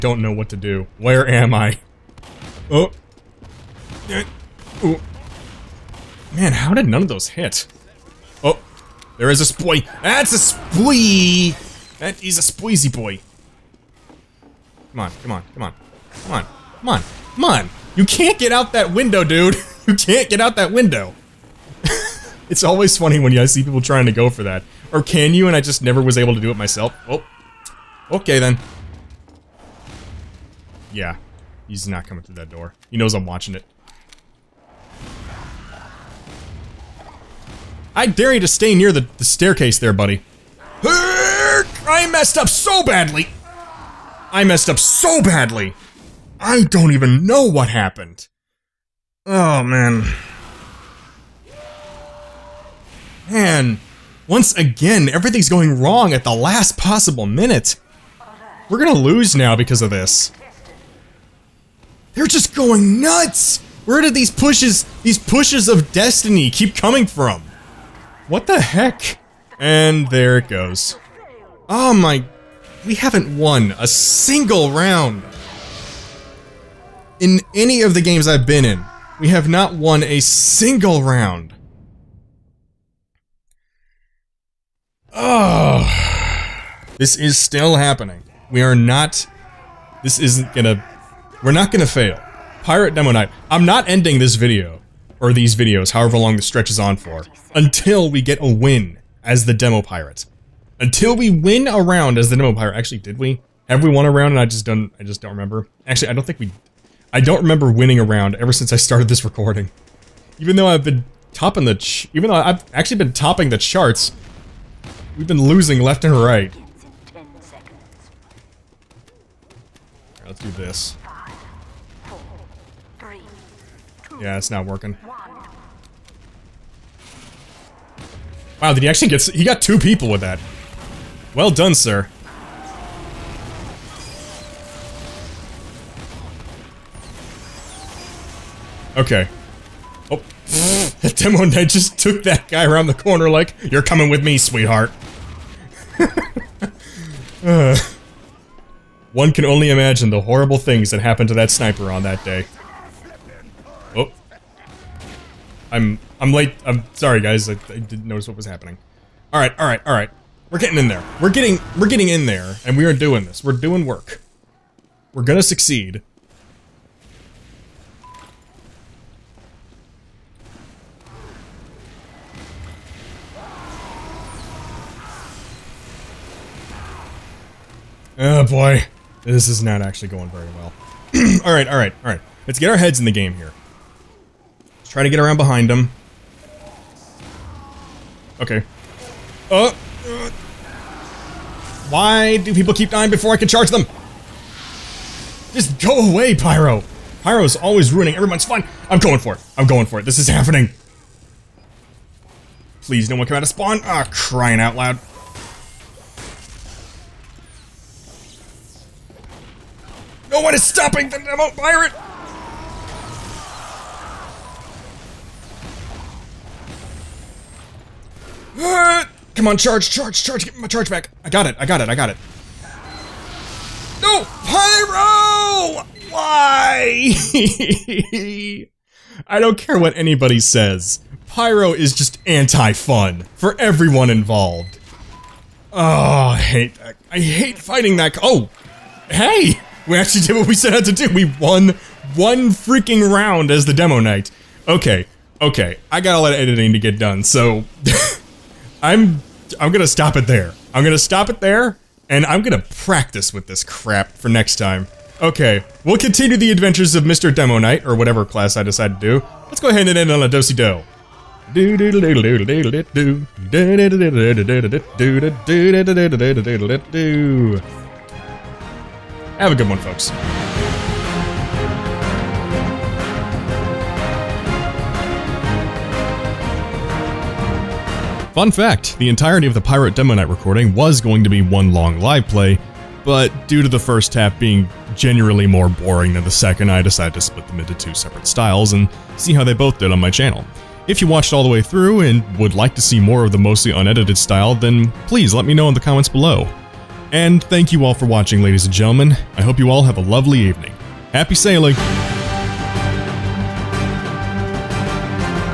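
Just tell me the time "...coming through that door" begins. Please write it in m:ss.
0:32.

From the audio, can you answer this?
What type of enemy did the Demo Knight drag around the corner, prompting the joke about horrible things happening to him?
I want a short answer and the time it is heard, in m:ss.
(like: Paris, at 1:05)
Sniper, at 2:31.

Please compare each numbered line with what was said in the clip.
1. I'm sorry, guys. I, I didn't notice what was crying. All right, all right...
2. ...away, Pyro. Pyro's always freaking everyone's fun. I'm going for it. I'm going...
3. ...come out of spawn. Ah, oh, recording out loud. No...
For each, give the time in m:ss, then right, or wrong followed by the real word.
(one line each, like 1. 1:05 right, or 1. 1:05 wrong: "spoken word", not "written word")
1. 2:36 wrong: "happening", not "crying"
2. 3:16 wrong: "ruining", not "freaking"
3. 3:23 wrong: "crying", not "recording".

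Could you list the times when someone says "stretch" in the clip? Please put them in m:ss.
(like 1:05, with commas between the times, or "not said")
1:36.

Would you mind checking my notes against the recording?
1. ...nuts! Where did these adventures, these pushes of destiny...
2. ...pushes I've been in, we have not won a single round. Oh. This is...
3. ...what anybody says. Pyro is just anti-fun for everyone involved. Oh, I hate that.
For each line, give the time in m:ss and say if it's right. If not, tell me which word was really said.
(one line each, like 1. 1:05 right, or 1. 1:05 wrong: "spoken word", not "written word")
1. 1:03 wrong: "pushes", not "adventures"
2. 1:18 wrong: "games", not "pushes"
3. 3:49 right.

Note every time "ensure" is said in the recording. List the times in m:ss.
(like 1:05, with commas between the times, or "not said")
not said.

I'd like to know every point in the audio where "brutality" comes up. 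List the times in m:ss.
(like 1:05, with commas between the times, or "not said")
not said.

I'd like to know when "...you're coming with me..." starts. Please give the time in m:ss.
2:23.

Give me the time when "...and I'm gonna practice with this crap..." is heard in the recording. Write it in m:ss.
4:12.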